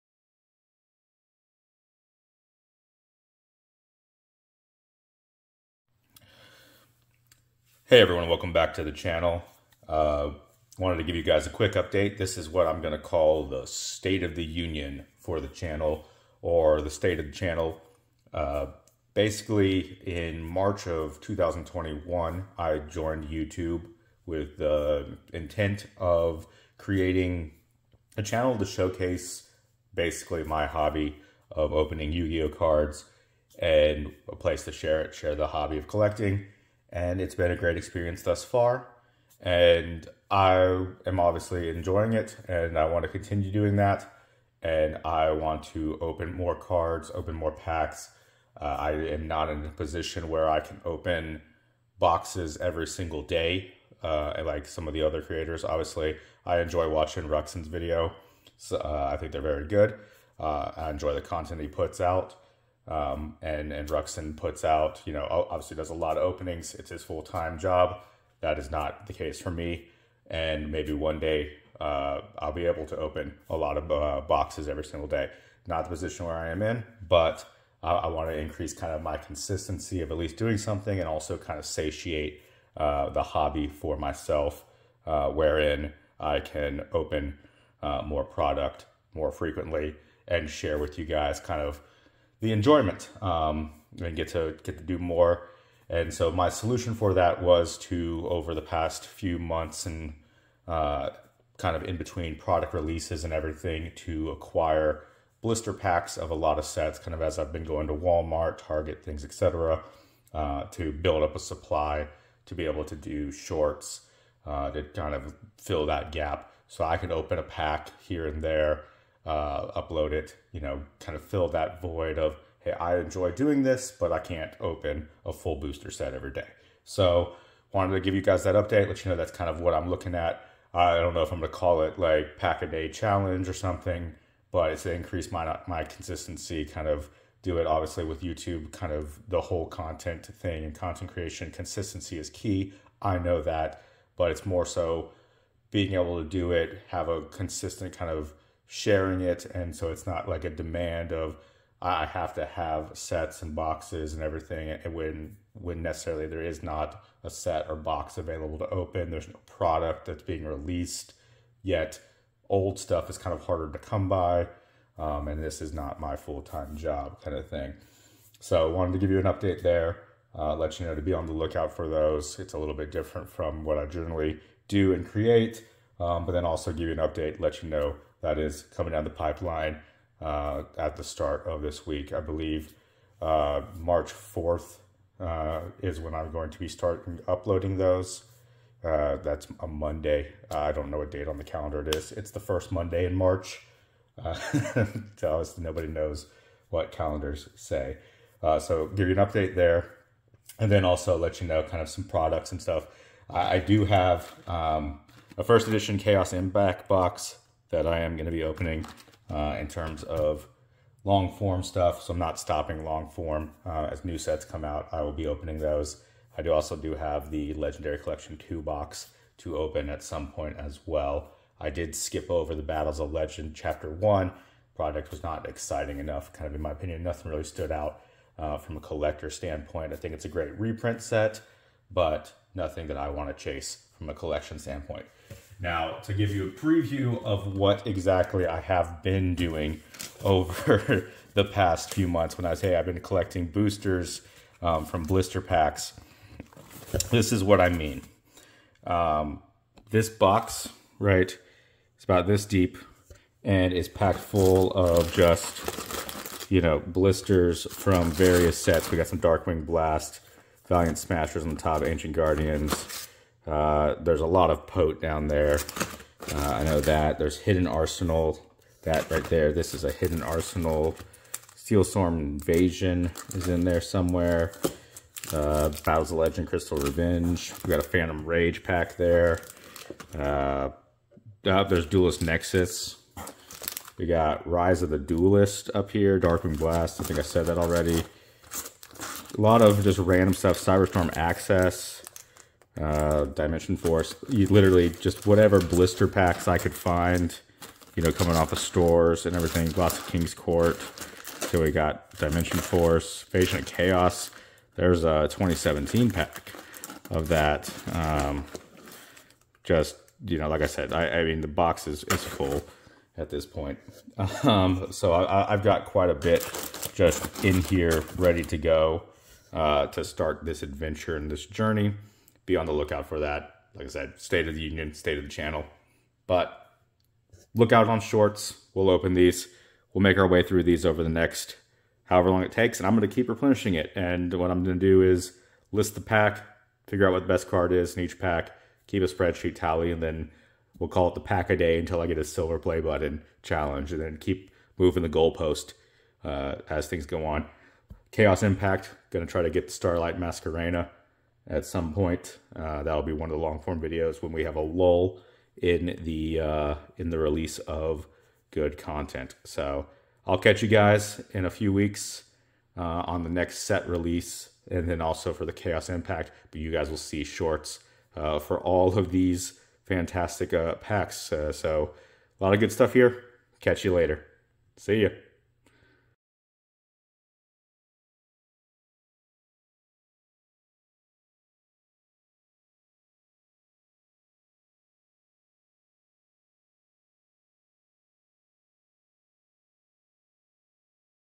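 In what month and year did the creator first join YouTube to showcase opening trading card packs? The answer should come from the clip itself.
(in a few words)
March 2021.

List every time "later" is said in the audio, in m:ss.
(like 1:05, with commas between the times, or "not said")
6:13.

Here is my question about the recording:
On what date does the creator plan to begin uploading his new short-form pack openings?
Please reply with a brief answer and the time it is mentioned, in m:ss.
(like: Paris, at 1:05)
March 4th, at 3:03.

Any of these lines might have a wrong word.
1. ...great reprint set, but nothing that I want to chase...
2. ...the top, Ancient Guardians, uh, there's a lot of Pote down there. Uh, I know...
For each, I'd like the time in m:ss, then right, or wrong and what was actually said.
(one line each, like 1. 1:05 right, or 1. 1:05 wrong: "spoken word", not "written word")
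1. 3:50 right
2. 4:21 right.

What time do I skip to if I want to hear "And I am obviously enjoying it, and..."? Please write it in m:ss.
0:39.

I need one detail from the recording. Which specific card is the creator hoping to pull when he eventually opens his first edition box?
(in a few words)
Starlight Masquerena.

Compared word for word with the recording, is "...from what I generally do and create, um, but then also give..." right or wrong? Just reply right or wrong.
right.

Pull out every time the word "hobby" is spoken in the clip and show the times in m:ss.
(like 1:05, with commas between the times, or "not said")
0:30, 0:35, 1:23.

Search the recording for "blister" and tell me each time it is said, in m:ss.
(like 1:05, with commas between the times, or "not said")
1:45, 4:05, 4:16, 4:55.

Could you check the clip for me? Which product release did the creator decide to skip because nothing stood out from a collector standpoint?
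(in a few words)
Battles of Legend Chapter 1.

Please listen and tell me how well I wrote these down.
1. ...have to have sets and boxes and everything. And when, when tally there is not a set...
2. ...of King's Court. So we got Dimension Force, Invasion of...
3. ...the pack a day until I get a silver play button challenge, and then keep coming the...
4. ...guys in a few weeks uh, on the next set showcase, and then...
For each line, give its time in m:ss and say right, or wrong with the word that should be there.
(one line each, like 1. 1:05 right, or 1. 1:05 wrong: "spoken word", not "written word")
1. 2:32 wrong: "necessarily", not "tally"
2. 4:59 right
3. 5:41 wrong: "moving", not "coming"
4. 6:00 wrong: "release", not "showcase".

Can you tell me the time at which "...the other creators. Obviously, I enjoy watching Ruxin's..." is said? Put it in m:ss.
0:54.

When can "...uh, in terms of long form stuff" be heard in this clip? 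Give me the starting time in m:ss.
3:29.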